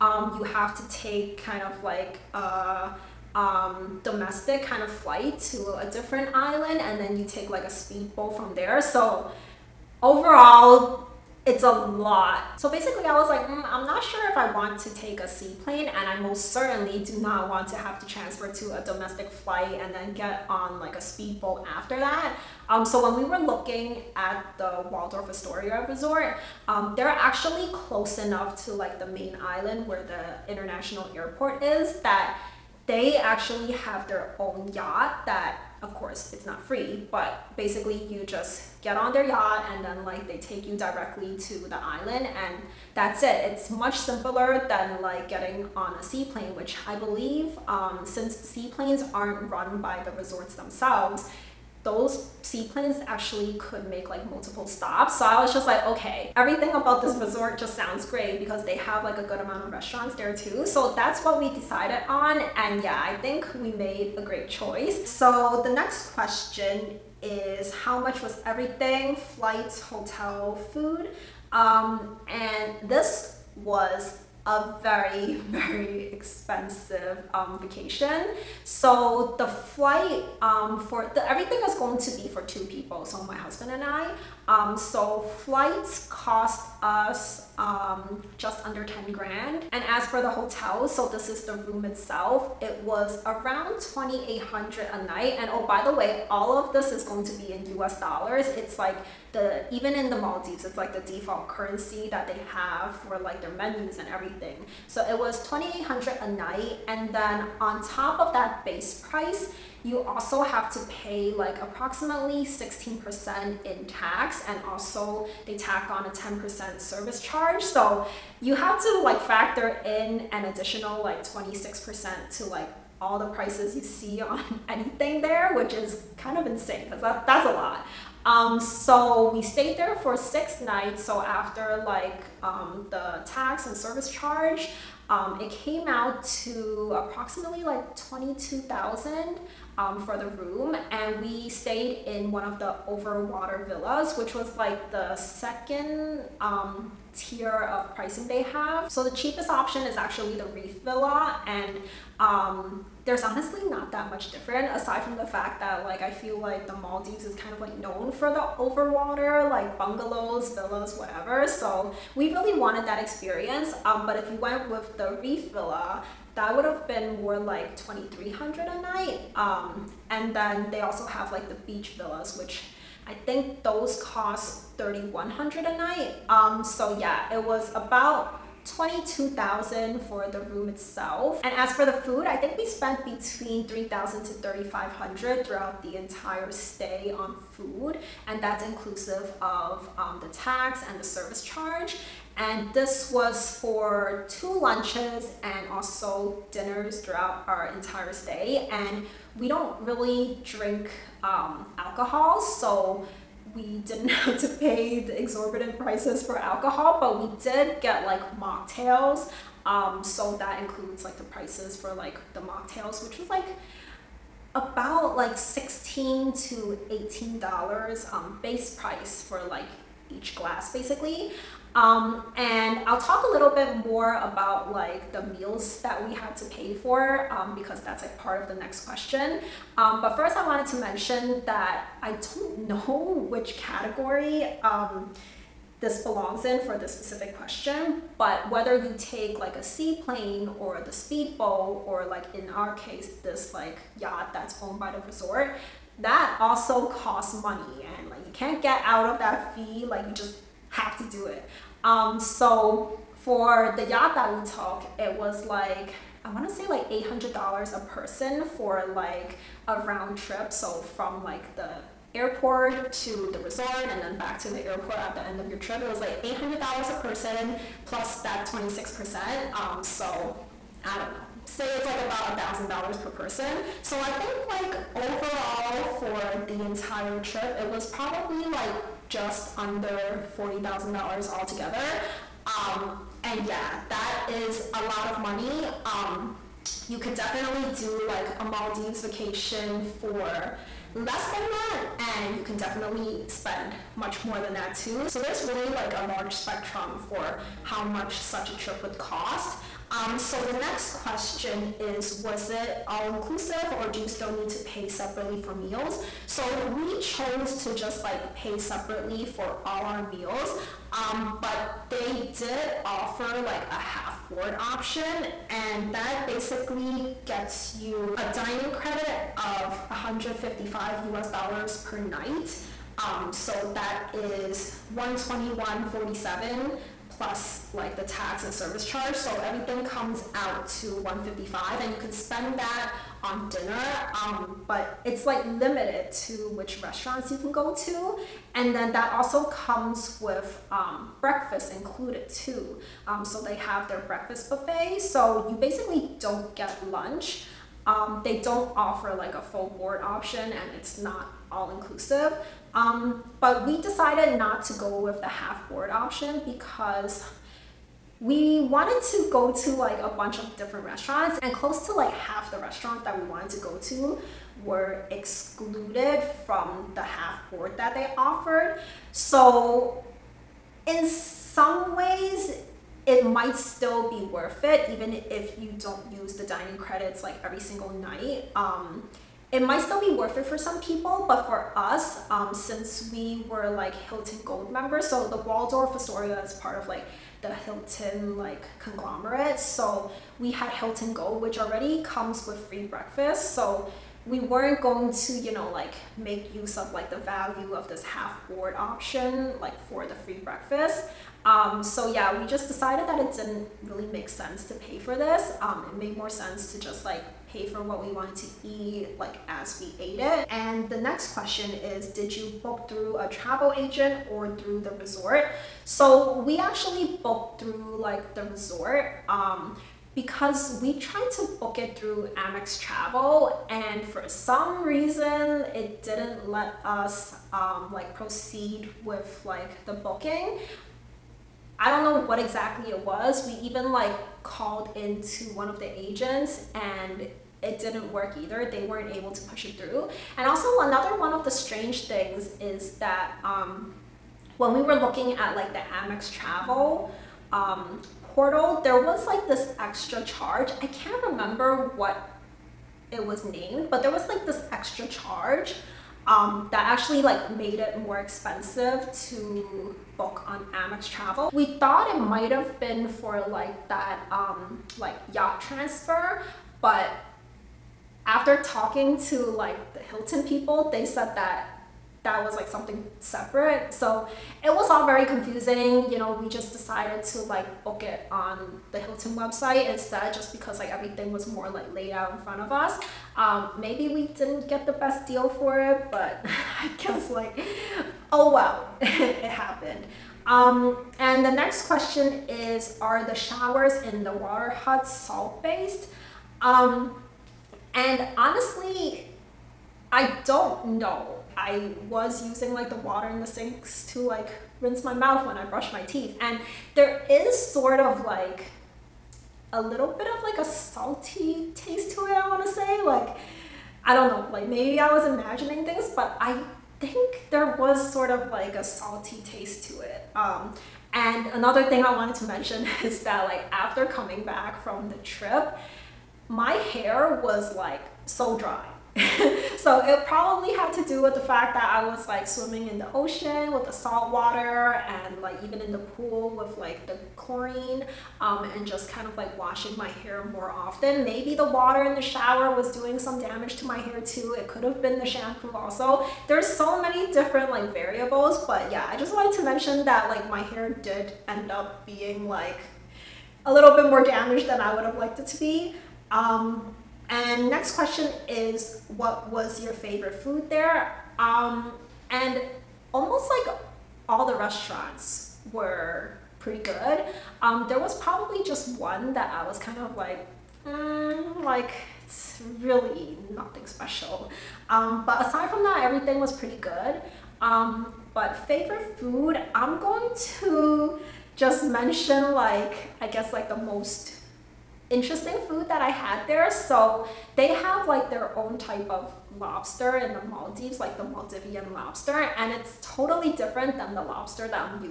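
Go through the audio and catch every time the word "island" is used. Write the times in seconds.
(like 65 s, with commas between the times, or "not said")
6 s, 29 s, 41 s.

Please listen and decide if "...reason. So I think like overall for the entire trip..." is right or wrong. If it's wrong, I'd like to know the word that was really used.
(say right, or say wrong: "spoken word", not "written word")
wrong: "person", not "reason".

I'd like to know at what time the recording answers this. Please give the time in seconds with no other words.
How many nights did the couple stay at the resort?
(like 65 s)
130 s.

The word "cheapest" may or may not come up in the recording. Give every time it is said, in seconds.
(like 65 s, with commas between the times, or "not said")
149 s.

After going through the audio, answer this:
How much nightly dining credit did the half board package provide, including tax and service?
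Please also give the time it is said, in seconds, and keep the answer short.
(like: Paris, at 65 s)
$155, at 319 s.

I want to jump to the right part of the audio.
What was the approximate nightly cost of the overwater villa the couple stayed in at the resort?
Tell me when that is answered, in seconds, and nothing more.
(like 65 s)
93 s.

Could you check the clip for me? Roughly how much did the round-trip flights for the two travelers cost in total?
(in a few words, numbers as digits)
just under $10,000.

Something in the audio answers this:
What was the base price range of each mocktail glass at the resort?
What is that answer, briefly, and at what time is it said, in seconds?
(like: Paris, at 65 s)
$16 to $18, at 215 s.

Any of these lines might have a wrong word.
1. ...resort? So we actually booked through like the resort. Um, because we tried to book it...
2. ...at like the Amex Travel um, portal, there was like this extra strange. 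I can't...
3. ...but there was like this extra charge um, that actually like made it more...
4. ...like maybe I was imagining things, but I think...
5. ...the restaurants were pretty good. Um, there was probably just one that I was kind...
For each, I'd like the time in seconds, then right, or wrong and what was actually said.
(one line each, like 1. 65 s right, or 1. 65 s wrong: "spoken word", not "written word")
1. 414 s right
2. 445 s wrong: "charge", not "strange"
3. 453 s right
4. 514 s right
5. 564 s right.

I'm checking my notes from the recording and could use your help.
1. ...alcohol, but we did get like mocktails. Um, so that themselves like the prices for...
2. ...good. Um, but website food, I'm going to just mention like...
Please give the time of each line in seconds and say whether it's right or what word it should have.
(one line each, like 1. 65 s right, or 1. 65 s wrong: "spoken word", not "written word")
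1. 206 s wrong: "includes", not "themselves"
2. 576 s wrong: "favorite", not "website".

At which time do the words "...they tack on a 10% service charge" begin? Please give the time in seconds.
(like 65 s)
115 s.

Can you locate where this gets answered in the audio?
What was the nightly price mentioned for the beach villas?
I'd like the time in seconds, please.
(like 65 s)
174 s.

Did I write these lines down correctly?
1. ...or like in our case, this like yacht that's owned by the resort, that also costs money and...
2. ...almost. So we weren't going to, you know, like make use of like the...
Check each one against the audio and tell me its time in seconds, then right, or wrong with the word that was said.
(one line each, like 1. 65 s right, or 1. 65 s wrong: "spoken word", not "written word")
1. 241 s right
2. 392 s wrong: "breakfast", not "almost".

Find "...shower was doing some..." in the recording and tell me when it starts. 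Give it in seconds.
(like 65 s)
542 s.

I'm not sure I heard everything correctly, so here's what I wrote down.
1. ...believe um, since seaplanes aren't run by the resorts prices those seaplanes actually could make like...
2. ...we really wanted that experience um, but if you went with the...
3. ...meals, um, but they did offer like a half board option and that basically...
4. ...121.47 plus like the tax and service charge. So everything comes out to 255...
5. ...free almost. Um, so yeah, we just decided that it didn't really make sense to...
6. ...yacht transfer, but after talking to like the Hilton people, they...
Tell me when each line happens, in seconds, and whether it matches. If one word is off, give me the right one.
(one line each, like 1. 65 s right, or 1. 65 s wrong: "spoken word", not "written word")
1. 46 s wrong: "themselves", not "prices"
2. 162 s right
3. 310 s right
4. 324 s wrong: "155", not "255"
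5. 400 s wrong: "breakfast", not "almost"
6. 465 s right.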